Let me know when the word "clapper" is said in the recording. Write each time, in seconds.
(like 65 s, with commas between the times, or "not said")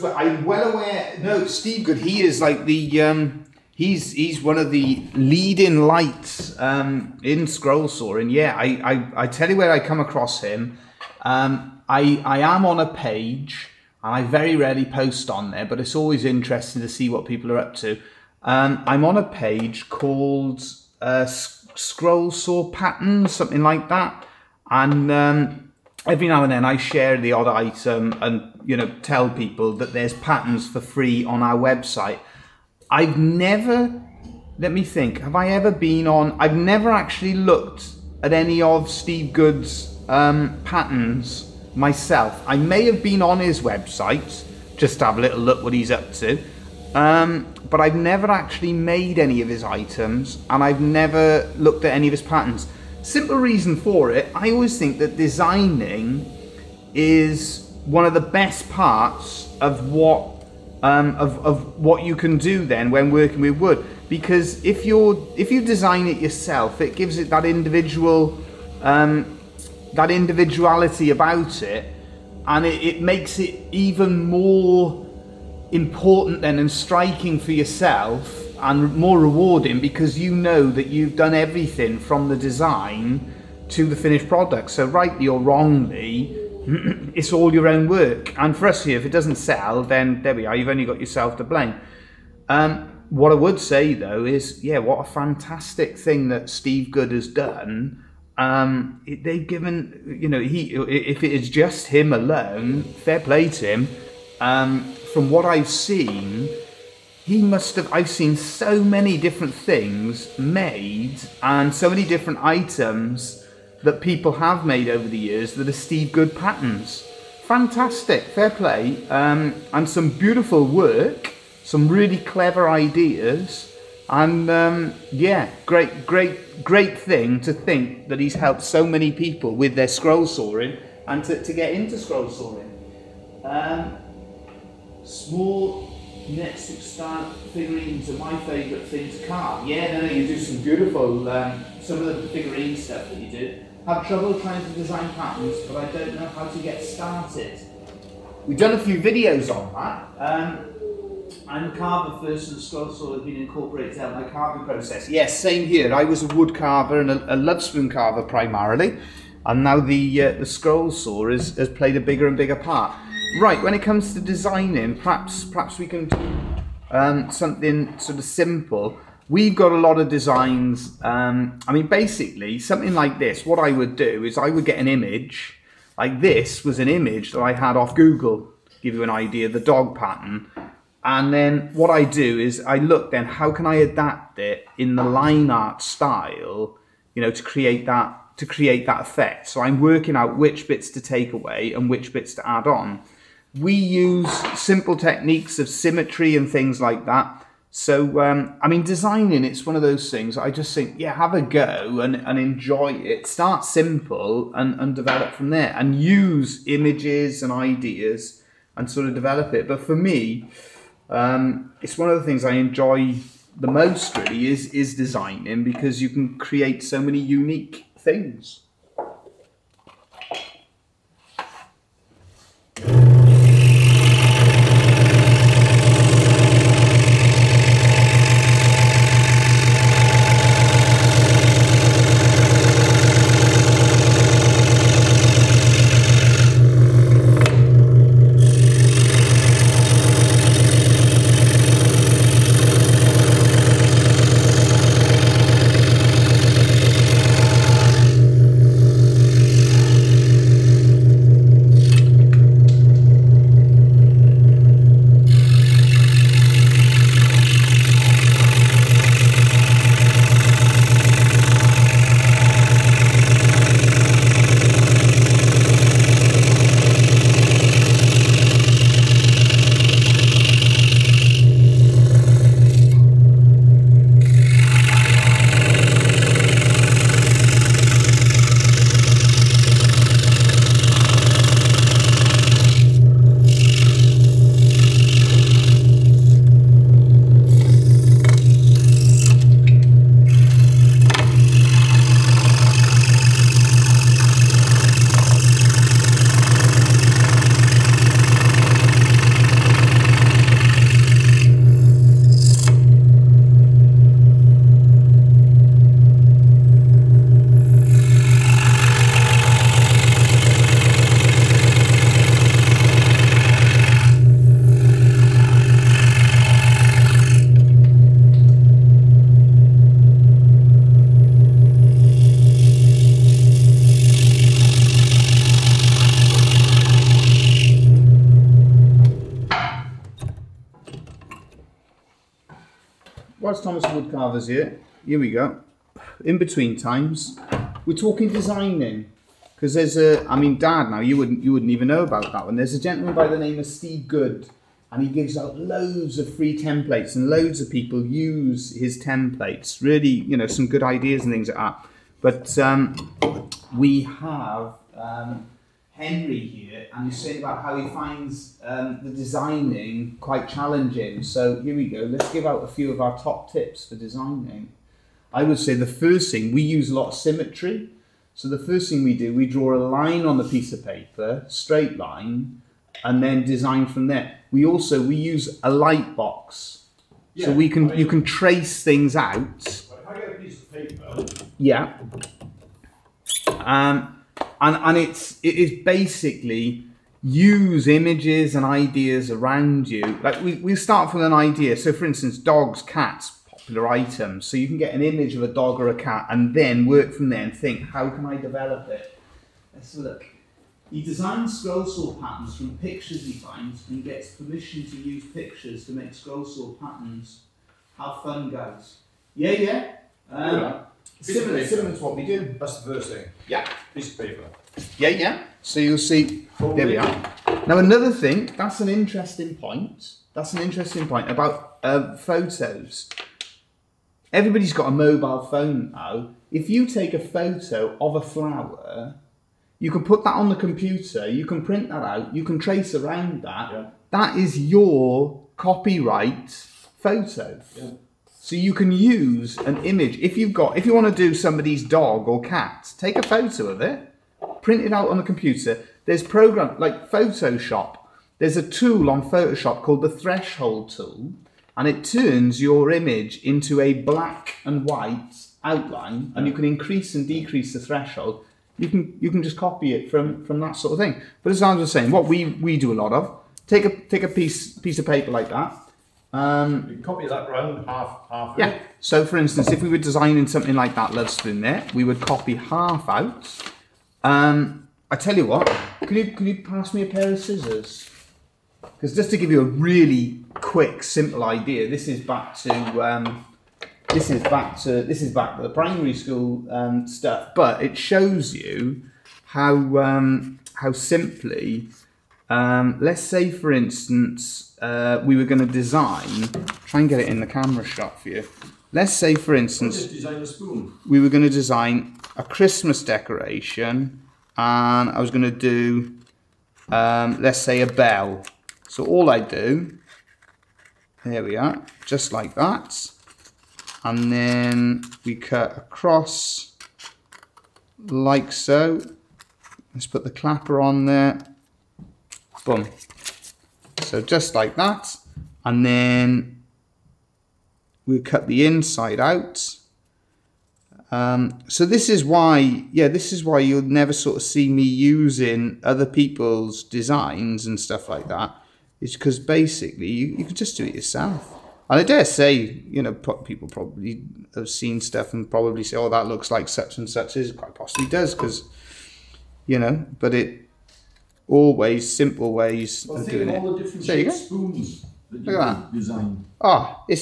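520 s.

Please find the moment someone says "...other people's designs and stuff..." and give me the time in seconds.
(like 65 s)
535 s.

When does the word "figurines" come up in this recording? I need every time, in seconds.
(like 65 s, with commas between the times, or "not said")
137 s, 142 s.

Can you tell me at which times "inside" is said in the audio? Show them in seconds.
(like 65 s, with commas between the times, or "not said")
528 s.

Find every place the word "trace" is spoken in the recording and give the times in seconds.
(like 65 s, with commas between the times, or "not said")
378 s, 432 s.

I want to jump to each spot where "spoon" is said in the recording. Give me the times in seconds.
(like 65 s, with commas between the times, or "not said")
471 s, 554 s.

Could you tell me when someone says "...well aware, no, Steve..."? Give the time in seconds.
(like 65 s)
0 s.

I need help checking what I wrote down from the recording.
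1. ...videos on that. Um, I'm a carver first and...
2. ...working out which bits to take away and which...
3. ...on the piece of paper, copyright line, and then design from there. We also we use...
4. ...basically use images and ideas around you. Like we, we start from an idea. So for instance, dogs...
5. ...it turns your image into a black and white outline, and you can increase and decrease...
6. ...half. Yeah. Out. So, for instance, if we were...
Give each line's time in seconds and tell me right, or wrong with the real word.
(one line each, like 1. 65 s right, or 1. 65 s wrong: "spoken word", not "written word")
1. 148 s right
2. 189 s right
3. 370 s wrong: "straight", not "copyright"
4. 385 s right
5. 451 s right
6. 468 s right.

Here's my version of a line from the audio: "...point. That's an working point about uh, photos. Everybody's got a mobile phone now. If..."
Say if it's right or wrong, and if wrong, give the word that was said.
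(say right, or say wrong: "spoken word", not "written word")
wrong: "interesting", not "working".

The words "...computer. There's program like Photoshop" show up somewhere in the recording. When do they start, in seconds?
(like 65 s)
445 s.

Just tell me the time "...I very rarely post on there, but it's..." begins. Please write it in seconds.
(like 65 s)
14 s.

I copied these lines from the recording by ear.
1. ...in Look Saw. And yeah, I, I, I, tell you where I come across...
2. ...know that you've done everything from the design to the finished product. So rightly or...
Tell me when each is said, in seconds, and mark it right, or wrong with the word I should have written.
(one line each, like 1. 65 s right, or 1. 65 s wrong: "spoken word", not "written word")
1. 7 s wrong: "Scroll", not "Look"
2. 80 s right.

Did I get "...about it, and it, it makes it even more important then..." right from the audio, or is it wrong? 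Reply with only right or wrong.
right.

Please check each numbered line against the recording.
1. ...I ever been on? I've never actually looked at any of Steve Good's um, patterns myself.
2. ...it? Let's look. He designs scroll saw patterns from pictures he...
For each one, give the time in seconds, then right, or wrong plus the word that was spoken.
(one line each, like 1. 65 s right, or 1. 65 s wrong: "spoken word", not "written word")
1. 35 s right
2. 398 s right.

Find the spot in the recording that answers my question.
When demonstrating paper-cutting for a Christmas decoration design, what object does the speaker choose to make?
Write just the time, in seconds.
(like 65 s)
507 s.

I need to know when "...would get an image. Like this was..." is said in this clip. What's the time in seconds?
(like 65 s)
174 s.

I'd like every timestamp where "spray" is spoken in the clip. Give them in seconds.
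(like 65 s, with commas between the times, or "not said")
not said.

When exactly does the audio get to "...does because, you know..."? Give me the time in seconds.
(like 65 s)
548 s.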